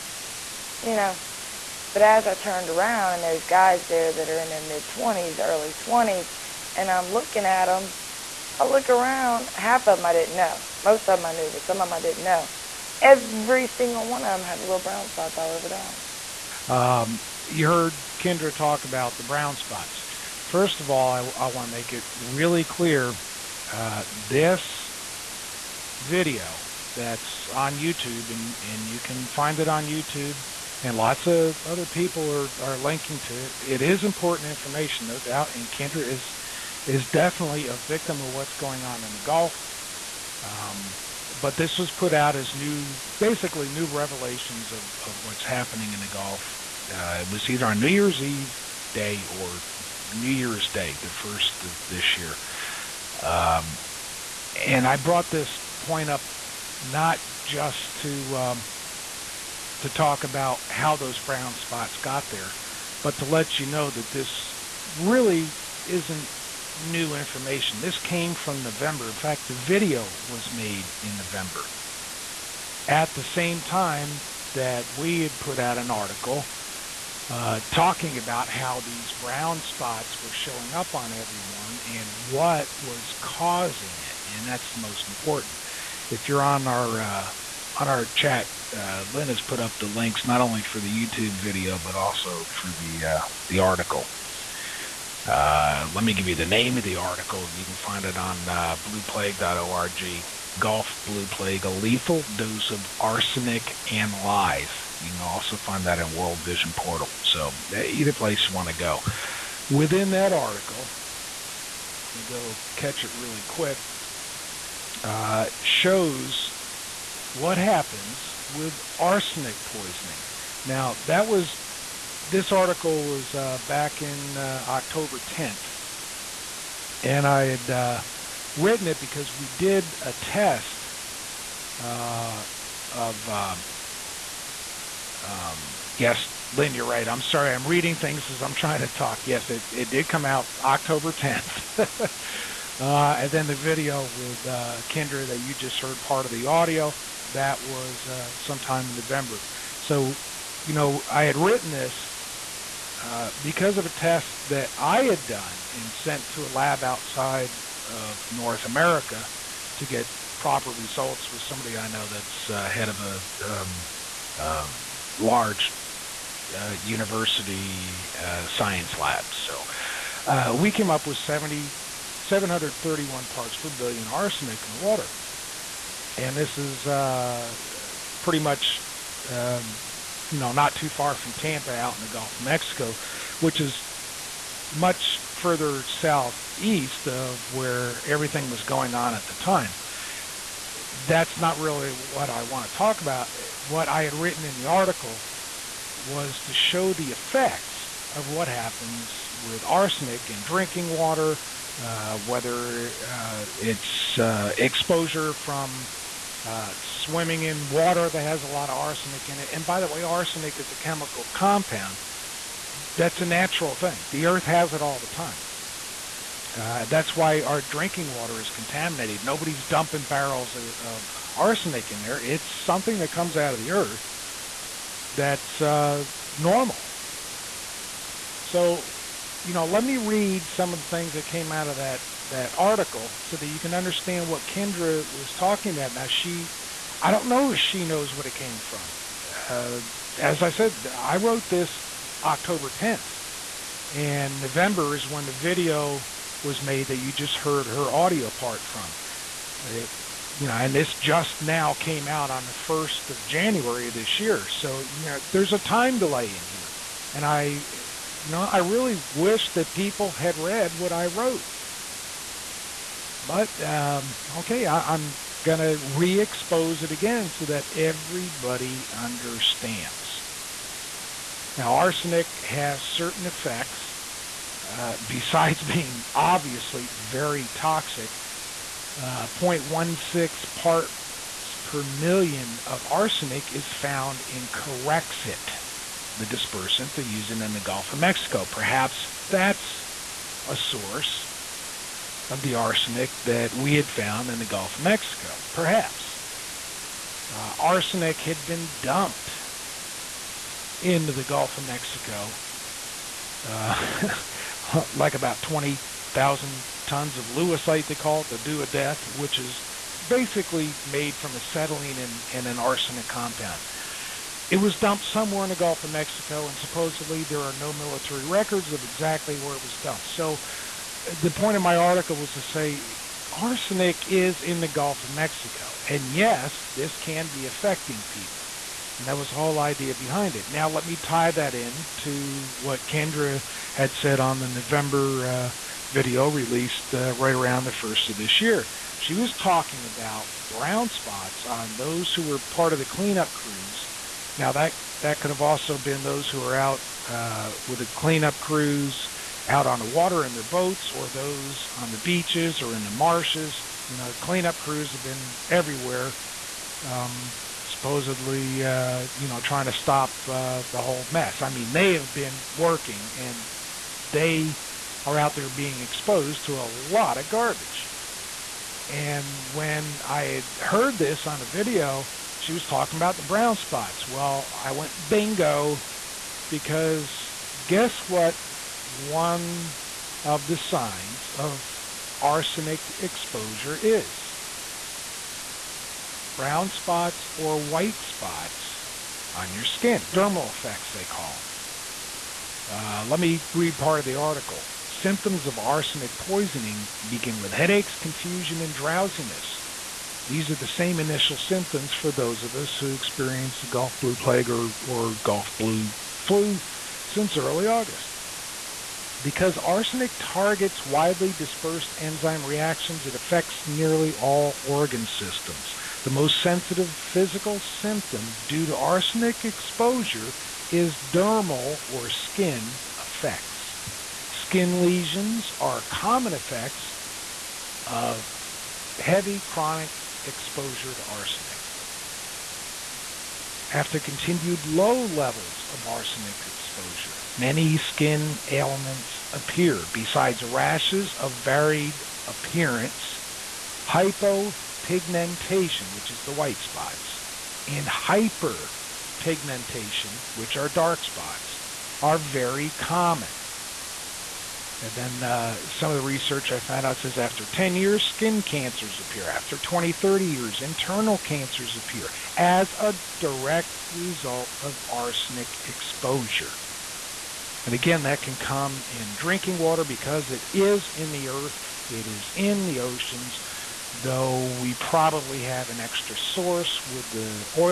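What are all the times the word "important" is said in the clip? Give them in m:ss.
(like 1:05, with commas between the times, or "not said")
0:34, 1:25.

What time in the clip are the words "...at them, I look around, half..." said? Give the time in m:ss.
0:07.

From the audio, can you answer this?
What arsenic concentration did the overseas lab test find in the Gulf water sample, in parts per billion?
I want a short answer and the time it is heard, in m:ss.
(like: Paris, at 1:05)
731, at 2:52.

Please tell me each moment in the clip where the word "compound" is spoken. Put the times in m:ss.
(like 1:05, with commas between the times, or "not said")
3:31, 5:13.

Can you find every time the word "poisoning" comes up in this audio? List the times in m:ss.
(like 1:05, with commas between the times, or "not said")
1:59, 6:36.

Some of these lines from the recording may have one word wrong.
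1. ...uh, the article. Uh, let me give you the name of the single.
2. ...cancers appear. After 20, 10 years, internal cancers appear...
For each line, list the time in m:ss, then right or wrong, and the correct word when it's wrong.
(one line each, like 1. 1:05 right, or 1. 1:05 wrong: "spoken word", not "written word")
1. 1:33 wrong: "article", not "single"
2. 7:38 wrong: "30", not "10".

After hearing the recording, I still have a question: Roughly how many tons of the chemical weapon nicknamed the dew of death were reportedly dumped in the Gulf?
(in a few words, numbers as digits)
20,000.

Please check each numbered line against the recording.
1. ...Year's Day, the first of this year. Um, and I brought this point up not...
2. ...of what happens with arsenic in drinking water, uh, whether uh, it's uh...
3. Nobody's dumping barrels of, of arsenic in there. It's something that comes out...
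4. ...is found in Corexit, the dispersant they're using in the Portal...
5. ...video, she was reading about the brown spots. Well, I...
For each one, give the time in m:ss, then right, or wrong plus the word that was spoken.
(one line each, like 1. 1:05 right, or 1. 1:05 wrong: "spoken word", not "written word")
1. 0:50 right
2. 3:18 right
3. 3:39 right
4. 4:43 wrong: "Gulf", not "Portal"
5. 6:11 wrong: "talking", not "reading".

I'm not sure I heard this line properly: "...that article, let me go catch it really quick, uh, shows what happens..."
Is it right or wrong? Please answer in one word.
right.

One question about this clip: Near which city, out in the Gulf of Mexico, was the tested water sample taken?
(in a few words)
Tampa.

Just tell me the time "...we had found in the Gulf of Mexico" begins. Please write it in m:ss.
4:53.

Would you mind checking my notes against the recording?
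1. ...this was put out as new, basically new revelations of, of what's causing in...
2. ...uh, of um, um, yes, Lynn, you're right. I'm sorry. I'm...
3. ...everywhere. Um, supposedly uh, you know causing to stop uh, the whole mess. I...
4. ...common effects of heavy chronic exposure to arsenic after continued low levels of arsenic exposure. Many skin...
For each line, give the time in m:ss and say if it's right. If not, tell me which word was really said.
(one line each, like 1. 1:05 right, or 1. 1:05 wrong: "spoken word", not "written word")
1. 0:41 wrong: "happening", not "causing"
2. 2:11 right
3. 5:55 wrong: "trying", not "causing"
4. 7:06 right.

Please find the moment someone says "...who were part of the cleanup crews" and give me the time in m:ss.
5:42.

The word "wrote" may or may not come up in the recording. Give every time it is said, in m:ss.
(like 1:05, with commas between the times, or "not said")
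4:01, 4:21.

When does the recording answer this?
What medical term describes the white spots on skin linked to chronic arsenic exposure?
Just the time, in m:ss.
7:23.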